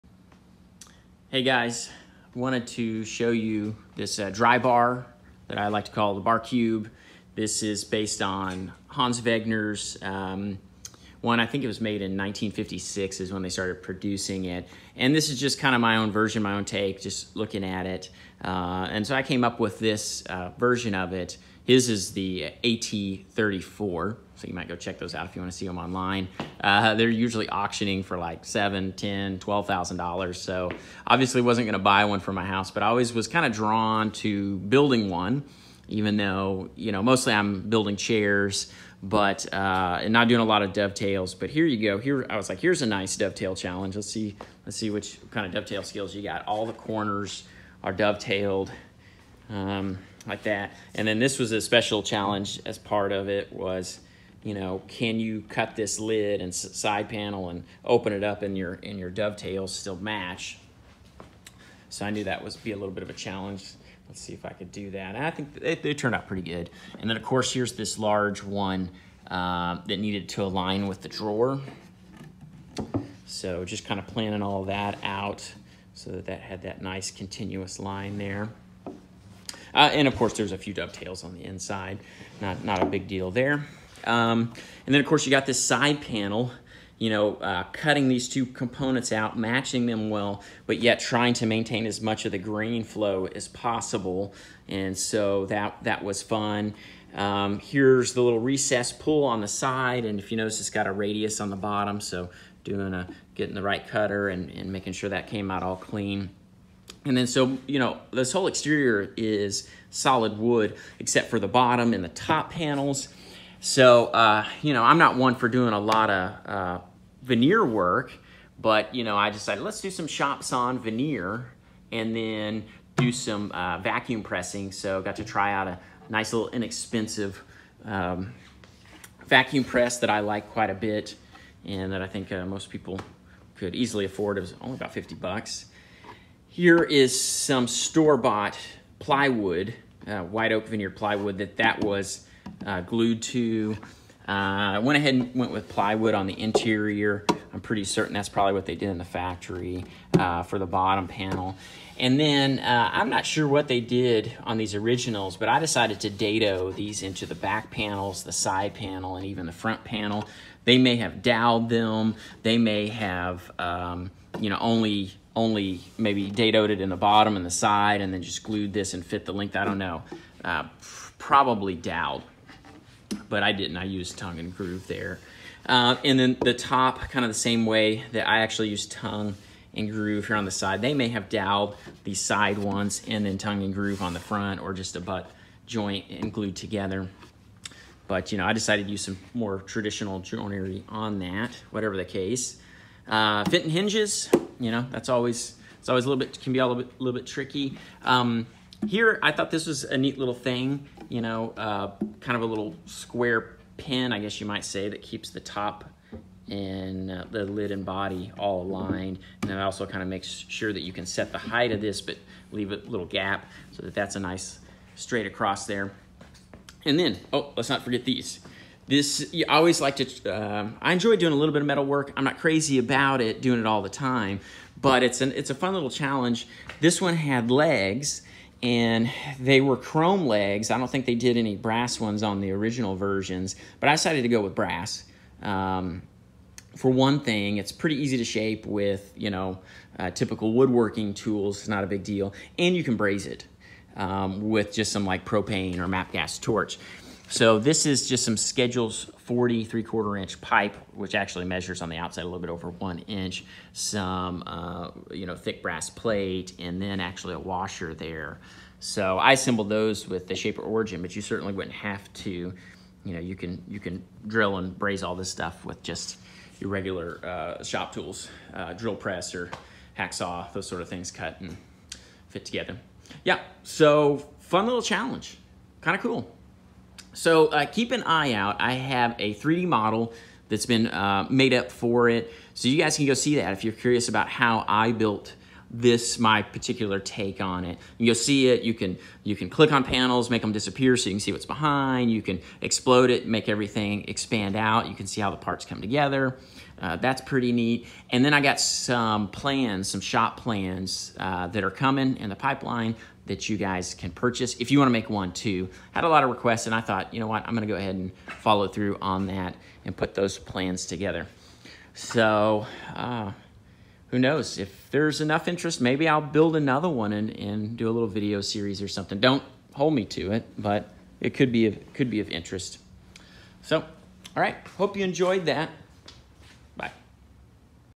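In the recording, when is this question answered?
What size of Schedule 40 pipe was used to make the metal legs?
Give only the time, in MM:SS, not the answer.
04:09.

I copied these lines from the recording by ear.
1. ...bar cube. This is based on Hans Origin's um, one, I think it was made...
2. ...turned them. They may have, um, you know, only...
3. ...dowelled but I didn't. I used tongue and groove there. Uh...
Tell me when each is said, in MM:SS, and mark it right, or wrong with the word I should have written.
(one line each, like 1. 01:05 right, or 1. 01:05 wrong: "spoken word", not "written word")
1. 00:06 wrong: "Wegner", not "Origin"
2. 02:41 wrong: "dowelled", not "turned"
3. 02:51 right.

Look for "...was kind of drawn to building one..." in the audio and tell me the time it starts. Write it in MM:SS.
00:33.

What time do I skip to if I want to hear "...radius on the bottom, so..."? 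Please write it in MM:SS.
01:40.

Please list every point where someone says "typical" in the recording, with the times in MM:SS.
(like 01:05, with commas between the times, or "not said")
04:00.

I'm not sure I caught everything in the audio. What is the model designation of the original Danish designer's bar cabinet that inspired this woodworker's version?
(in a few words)
AT34.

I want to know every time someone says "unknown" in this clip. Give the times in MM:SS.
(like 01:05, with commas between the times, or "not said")
not said.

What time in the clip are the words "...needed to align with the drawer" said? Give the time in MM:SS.
01:10.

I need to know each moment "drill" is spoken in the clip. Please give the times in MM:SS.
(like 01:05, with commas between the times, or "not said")
04:24, 04:28.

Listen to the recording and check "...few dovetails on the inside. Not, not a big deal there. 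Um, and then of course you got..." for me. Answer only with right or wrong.
right.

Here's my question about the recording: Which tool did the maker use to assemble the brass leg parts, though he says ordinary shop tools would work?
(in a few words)
Shaper Origin.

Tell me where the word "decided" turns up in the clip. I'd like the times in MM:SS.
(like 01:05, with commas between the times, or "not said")
01:59, 02:35, 03:08, 03:53.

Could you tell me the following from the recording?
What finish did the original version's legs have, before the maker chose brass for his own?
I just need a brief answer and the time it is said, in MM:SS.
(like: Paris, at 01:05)
Chrome, at 03:49.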